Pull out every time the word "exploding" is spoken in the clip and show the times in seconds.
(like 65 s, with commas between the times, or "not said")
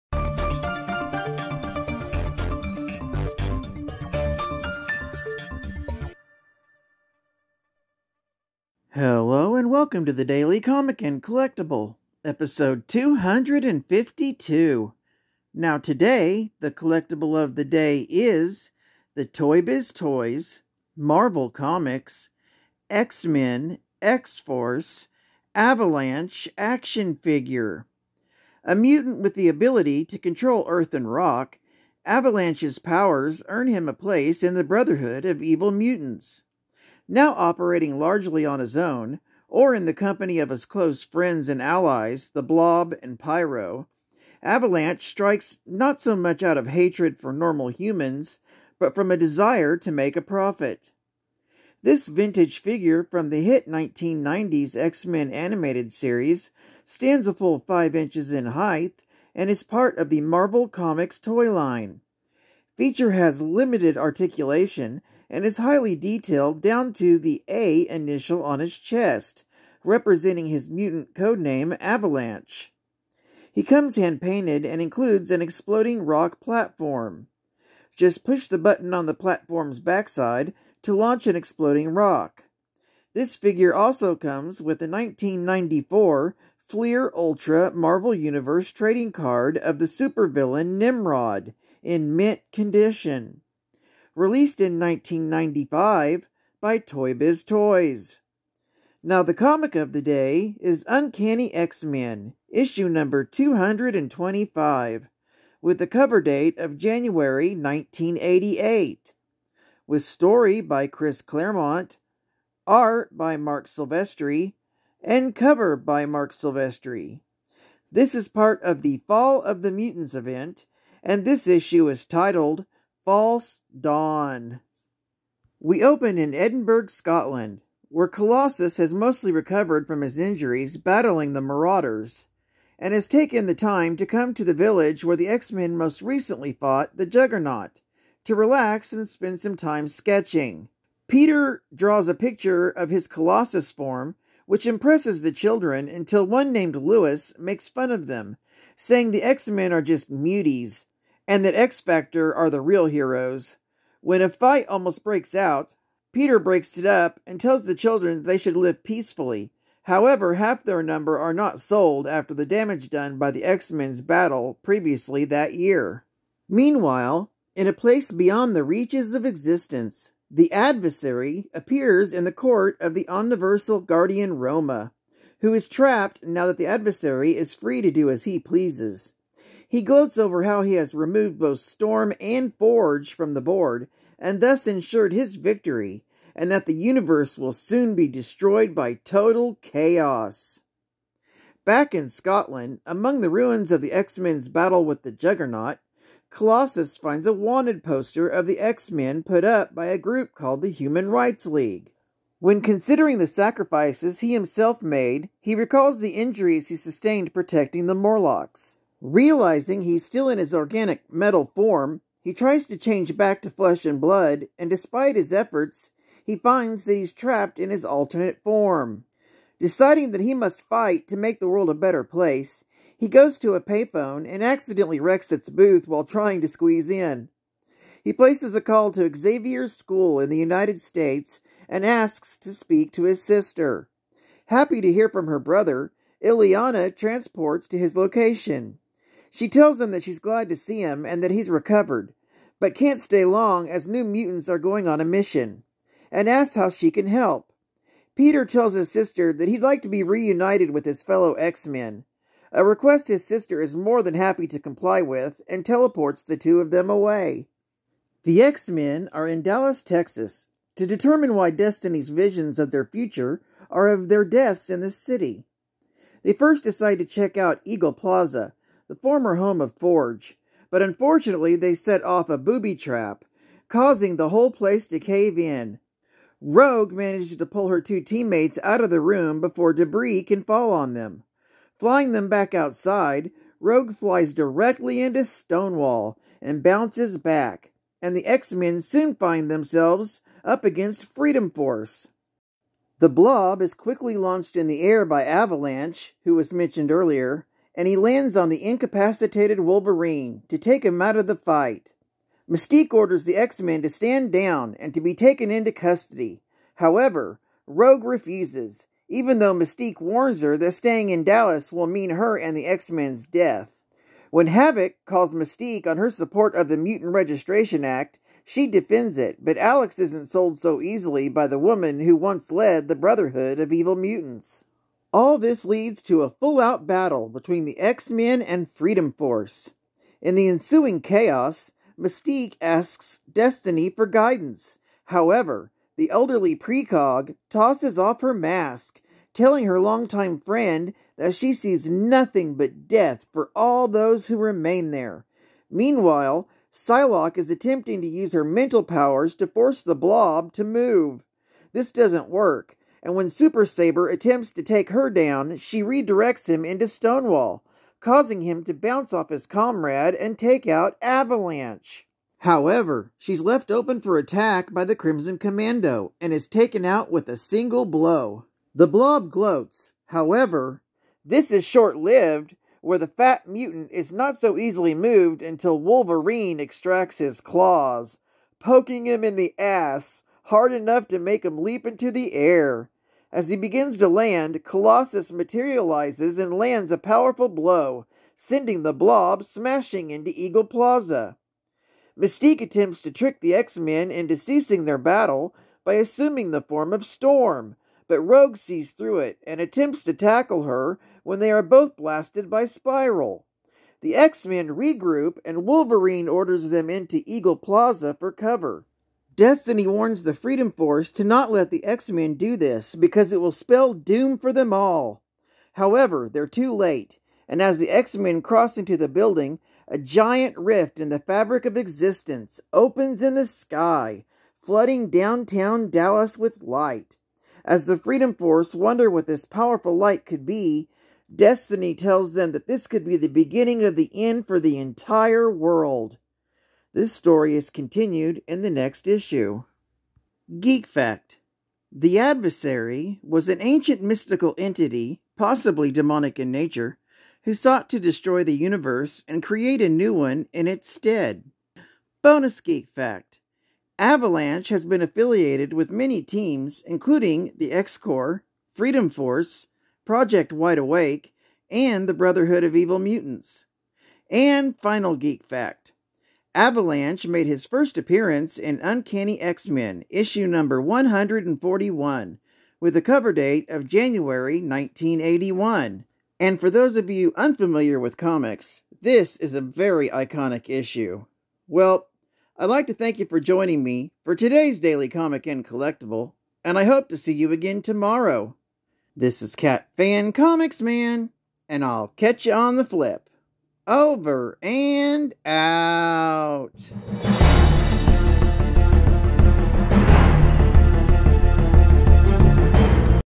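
75 s, 81 s.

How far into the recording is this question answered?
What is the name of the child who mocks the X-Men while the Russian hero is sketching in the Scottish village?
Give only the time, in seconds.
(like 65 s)
146 s.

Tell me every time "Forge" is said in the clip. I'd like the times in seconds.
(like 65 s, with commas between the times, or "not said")
182 s, 269 s.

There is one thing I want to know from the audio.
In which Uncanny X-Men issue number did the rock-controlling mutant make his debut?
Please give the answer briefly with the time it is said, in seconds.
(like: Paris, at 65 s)
141, at 470 s.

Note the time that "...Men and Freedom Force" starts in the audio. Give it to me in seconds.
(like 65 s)
328 s.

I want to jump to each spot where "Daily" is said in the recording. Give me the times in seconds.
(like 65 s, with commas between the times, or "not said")
10 s, 484 s.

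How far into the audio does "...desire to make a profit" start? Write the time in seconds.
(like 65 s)
49 s.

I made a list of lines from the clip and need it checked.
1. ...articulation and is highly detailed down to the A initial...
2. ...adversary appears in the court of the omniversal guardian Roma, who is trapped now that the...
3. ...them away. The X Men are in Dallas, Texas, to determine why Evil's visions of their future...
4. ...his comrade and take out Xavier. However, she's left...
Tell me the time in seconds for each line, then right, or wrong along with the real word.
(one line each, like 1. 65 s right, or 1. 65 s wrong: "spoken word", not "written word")
1. 63 s right
2. 170 s right
3. 256 s wrong: "Destiny", not "Evil"
4. 359 s wrong: "Avalanche", not "Xavier".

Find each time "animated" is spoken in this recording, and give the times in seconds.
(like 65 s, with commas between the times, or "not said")
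55 s.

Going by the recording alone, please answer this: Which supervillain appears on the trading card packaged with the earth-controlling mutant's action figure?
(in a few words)
Nimrod.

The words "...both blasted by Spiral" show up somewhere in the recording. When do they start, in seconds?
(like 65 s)
401 s.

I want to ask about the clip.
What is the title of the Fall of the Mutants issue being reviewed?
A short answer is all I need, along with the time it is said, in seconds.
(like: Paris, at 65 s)
False Dawn, at 123 s.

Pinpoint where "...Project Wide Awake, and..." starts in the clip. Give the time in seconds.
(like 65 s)
460 s.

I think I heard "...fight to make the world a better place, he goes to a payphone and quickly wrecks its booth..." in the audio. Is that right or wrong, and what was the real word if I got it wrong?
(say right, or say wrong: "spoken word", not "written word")
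wrong: "accidentally", not "quickly".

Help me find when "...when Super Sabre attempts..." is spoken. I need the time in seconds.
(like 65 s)
353 s.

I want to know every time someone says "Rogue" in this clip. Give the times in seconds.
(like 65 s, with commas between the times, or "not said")
276 s, 283 s, 307 s, 398 s.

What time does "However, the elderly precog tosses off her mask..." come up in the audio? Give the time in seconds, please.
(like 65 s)
335 s.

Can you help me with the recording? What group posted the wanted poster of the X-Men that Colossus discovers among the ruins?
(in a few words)
Human Rights League.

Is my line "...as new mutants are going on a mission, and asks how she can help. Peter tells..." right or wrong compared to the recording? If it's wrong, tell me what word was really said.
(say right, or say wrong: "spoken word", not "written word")
right.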